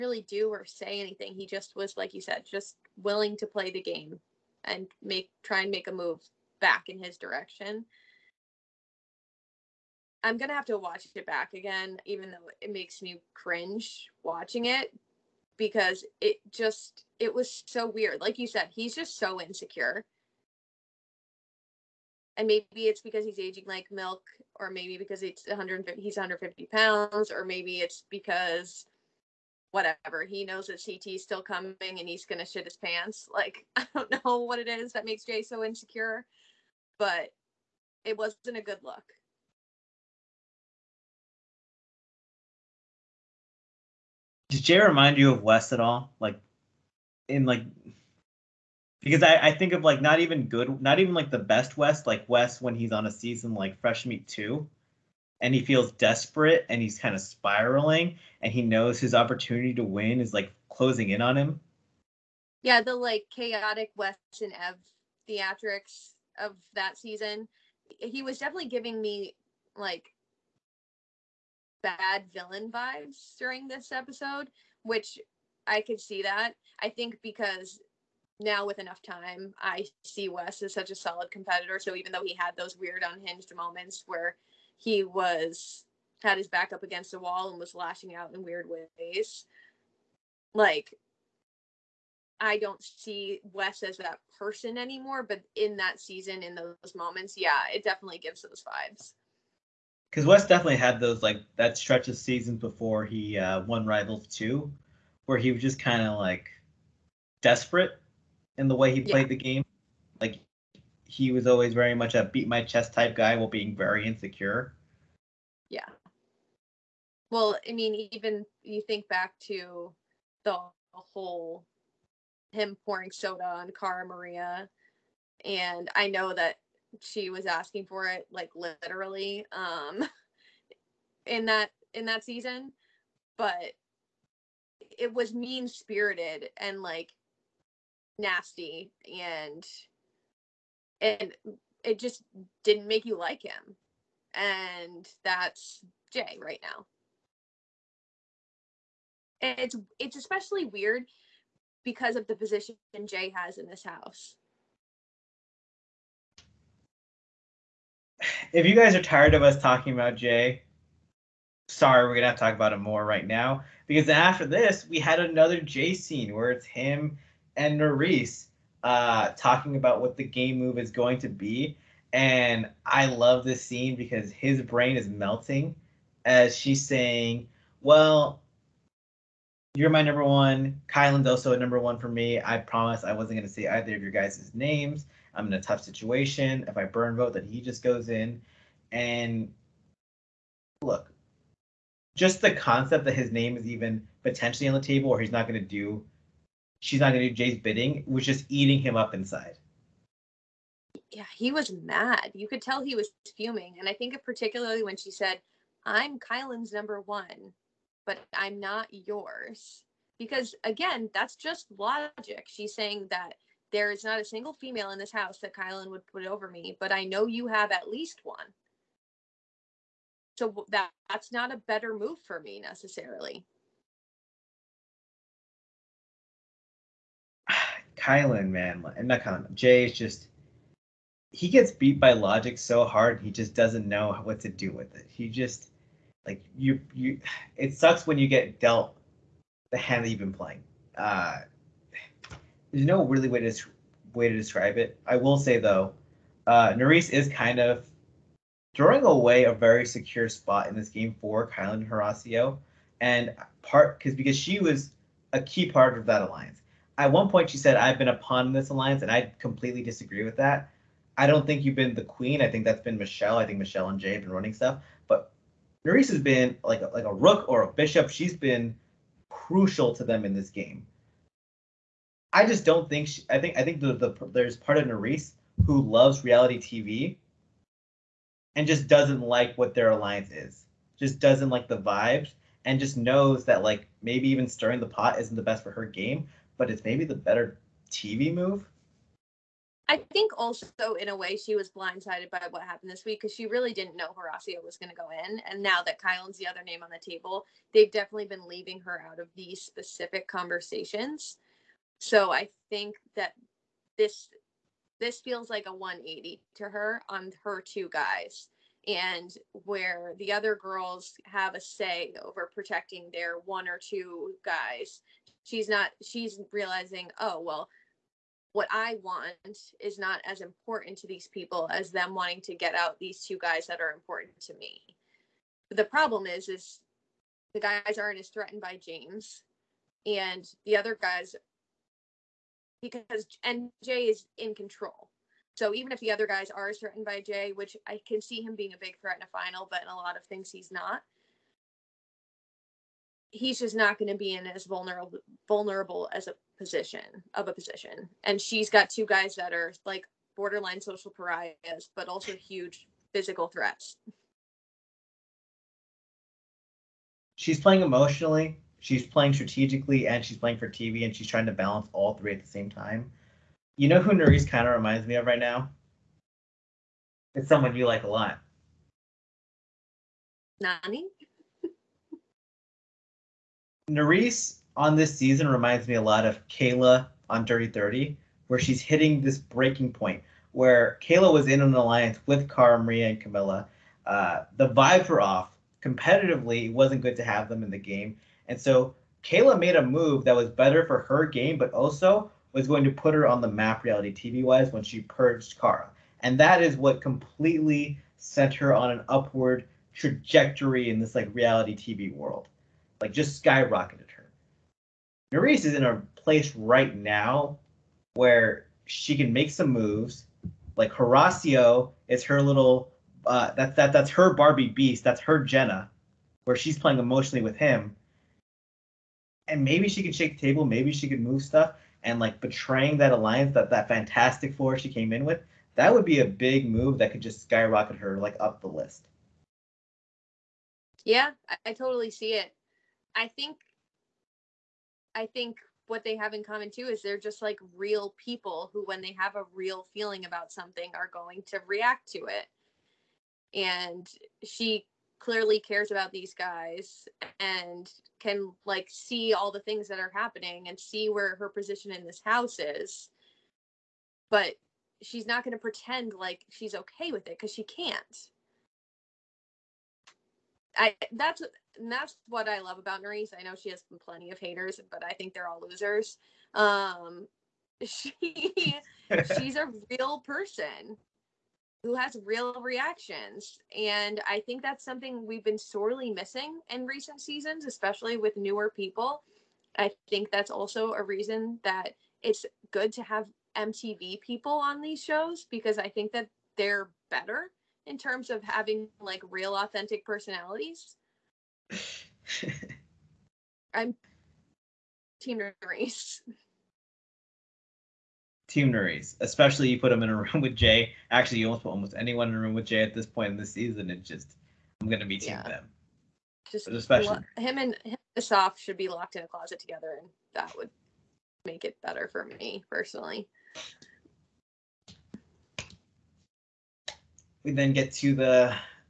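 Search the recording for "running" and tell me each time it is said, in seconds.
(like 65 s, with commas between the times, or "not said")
264 s.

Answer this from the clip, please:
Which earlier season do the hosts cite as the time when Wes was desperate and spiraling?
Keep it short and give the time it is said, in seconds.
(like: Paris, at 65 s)
Fresh Meat 2, at 53 s.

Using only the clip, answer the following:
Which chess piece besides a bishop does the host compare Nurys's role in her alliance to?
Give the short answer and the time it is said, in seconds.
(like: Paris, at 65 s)
rook, at 267 s.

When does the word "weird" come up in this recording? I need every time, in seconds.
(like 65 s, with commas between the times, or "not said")
17 s, 82 s, 88 s, 150 s.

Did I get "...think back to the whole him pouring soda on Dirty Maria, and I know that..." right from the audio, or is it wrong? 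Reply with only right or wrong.
wrong.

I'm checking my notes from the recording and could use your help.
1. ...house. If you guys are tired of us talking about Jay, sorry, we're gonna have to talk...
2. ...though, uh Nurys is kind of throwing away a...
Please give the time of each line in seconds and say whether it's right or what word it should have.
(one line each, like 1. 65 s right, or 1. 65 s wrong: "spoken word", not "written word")
1. 153 s right
2. 245 s right.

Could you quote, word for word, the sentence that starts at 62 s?
Yeah, the like chaotic Wes and Ev theatrics of that season.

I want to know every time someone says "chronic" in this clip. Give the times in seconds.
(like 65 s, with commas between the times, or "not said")
not said.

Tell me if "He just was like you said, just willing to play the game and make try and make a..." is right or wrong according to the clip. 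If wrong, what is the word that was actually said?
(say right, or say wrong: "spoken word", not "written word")
right.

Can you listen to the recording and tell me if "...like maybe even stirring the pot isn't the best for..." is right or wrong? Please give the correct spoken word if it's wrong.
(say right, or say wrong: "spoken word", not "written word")
right.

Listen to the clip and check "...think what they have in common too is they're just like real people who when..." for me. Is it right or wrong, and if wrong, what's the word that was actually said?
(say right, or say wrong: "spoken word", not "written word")
right.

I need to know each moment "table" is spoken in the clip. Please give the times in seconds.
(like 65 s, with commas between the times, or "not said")
194 s, 297 s, 420 s.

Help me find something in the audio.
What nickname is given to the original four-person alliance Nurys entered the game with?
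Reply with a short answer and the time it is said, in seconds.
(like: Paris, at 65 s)
Fantastic Four, at 423 s.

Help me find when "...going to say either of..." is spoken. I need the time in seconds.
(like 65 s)
183 s.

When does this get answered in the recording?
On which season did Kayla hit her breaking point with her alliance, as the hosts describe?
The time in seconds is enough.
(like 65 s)
377 s.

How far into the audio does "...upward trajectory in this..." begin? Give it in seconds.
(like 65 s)
399 s.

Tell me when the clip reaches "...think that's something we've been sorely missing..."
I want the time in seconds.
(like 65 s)
474 s.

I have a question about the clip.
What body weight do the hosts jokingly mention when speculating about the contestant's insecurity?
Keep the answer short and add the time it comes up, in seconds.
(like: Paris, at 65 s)
150 pounds, at 26 s.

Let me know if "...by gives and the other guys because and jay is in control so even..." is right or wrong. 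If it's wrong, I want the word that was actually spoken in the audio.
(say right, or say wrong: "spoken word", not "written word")
wrong: "james", not "gives".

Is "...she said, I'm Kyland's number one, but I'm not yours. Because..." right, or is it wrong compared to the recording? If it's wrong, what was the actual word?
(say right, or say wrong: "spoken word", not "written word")
right.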